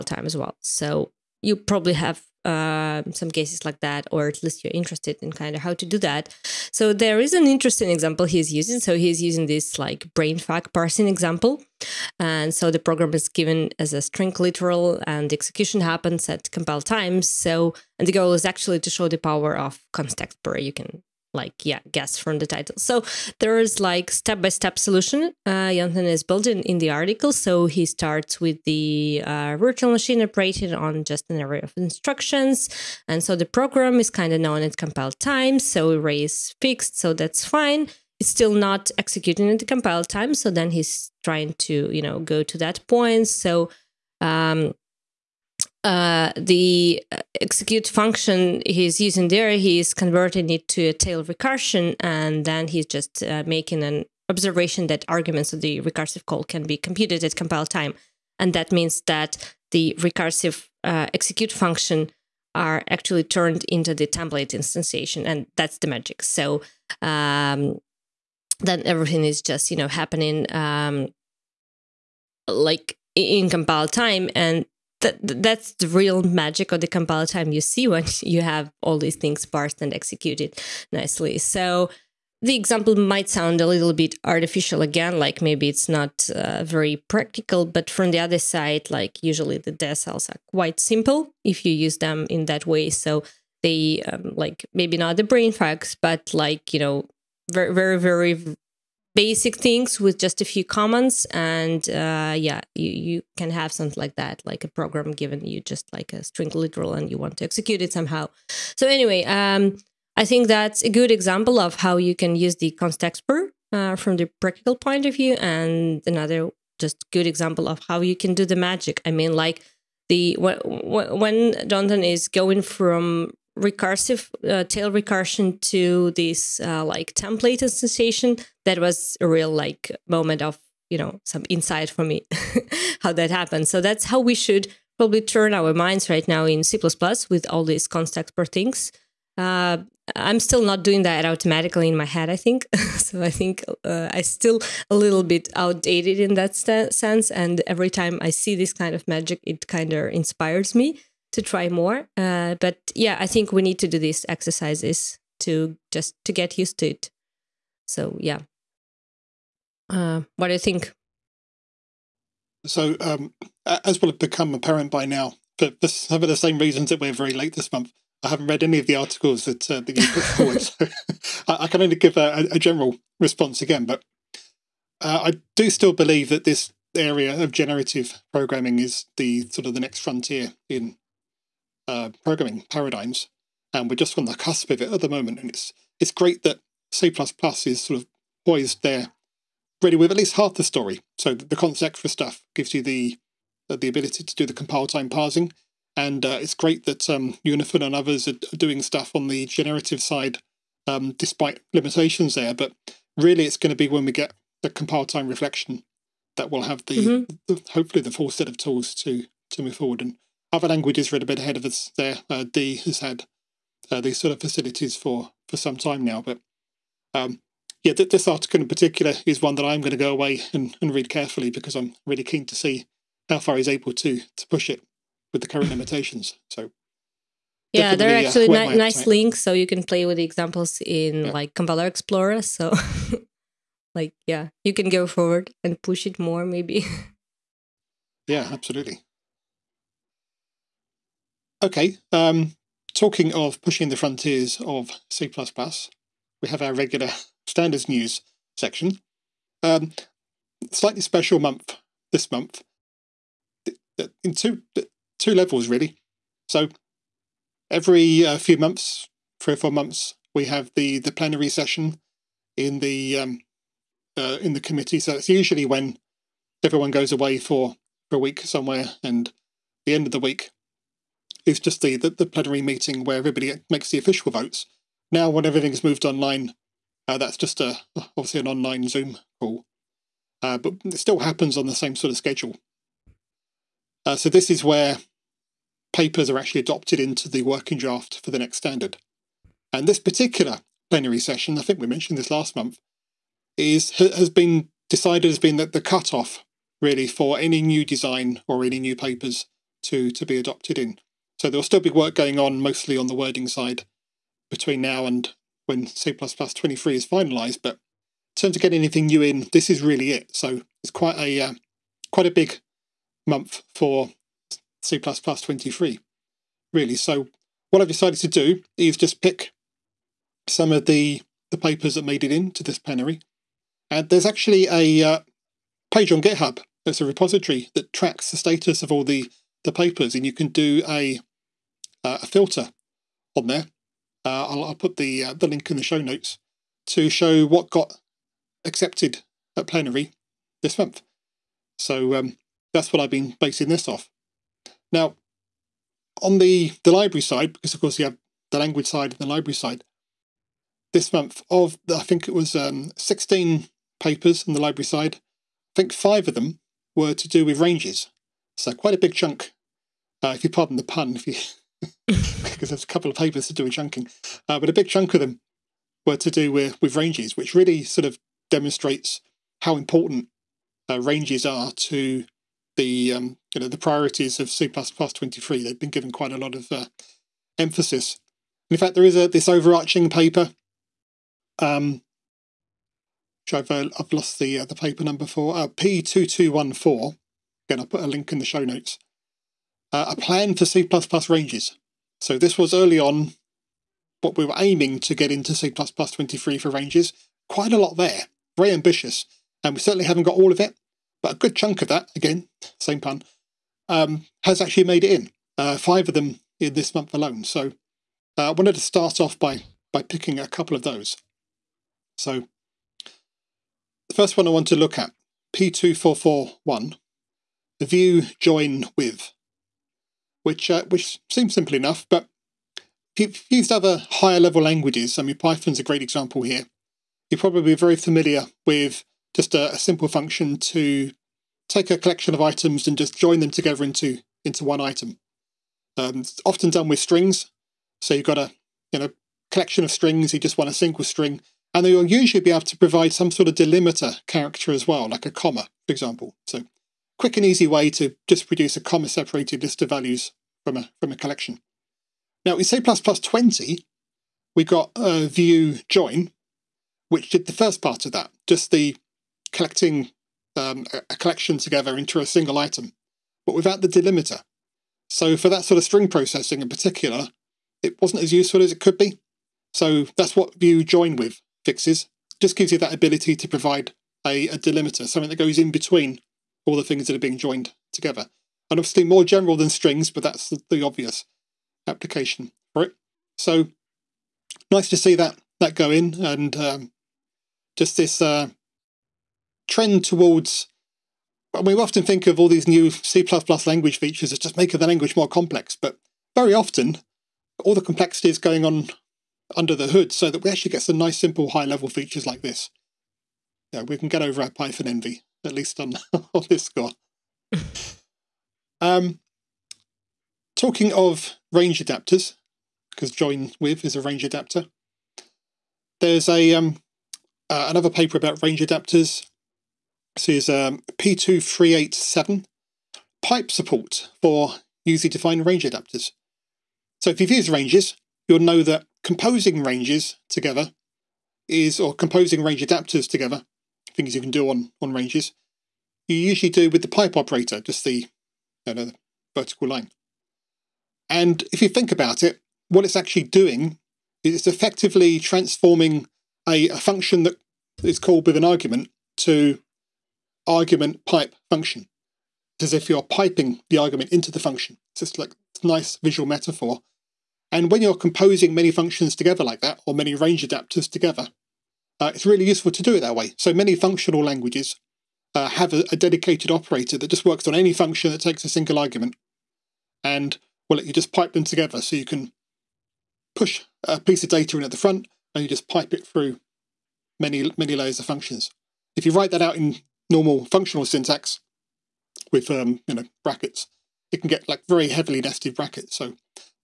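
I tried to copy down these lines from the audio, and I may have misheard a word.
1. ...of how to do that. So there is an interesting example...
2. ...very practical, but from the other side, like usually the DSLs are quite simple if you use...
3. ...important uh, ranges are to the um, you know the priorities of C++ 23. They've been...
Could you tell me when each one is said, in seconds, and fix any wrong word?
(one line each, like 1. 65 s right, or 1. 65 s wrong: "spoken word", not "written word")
1. 5 s right
2. 86 s right
3. 369 s right.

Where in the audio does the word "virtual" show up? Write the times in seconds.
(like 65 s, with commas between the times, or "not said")
29 s.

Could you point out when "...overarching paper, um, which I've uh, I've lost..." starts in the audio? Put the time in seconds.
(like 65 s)
379 s.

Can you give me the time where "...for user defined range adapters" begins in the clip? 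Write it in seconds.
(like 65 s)
524 s.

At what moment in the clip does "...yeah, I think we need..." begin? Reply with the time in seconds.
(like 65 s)
152 s.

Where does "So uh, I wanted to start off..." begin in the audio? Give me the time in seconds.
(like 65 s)
407 s.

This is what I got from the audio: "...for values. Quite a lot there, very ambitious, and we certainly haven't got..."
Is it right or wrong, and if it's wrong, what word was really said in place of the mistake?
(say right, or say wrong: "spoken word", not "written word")
wrong: "ranges", not "values".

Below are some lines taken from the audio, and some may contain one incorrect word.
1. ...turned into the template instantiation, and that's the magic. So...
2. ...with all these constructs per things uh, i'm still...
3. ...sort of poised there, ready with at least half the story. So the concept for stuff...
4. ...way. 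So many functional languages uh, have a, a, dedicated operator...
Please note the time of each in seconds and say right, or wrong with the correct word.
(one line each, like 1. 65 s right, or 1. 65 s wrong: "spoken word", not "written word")
1. 63 s right
2. 137 s right
3. 187 s right
4. 563 s right.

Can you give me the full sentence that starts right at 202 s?
But really, it's going to be when we get the compile time reflection that we'll have the, mm-hmm.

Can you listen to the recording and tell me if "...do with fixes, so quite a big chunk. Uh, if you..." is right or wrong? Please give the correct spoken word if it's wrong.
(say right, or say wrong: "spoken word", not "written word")
wrong: "ranges", not "fixes".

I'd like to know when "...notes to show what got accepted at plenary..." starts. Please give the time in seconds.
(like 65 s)
336 s.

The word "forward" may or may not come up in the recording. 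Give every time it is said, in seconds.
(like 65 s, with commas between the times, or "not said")
170 s, 209 s, 235 s.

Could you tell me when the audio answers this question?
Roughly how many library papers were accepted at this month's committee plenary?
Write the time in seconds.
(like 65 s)
352 s.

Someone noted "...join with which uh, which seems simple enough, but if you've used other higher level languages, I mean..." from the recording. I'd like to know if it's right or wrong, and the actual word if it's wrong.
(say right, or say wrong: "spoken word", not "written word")
right.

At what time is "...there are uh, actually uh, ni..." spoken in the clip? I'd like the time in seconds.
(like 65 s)
227 s.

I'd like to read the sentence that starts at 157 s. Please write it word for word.
So yeah, uh, what do you think?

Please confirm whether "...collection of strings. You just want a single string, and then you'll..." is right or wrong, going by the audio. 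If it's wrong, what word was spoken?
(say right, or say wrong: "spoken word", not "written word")
right.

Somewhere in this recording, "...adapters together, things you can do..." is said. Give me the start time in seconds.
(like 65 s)
532 s.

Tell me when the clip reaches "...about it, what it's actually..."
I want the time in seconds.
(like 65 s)
541 s.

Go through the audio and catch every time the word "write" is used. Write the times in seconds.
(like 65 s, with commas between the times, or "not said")
579 s.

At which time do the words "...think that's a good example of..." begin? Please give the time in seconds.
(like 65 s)
110 s.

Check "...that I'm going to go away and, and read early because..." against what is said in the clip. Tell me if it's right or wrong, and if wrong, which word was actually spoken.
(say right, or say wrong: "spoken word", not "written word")
wrong: "carefully", not "early".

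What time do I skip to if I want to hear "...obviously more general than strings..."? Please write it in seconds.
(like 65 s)
478 s.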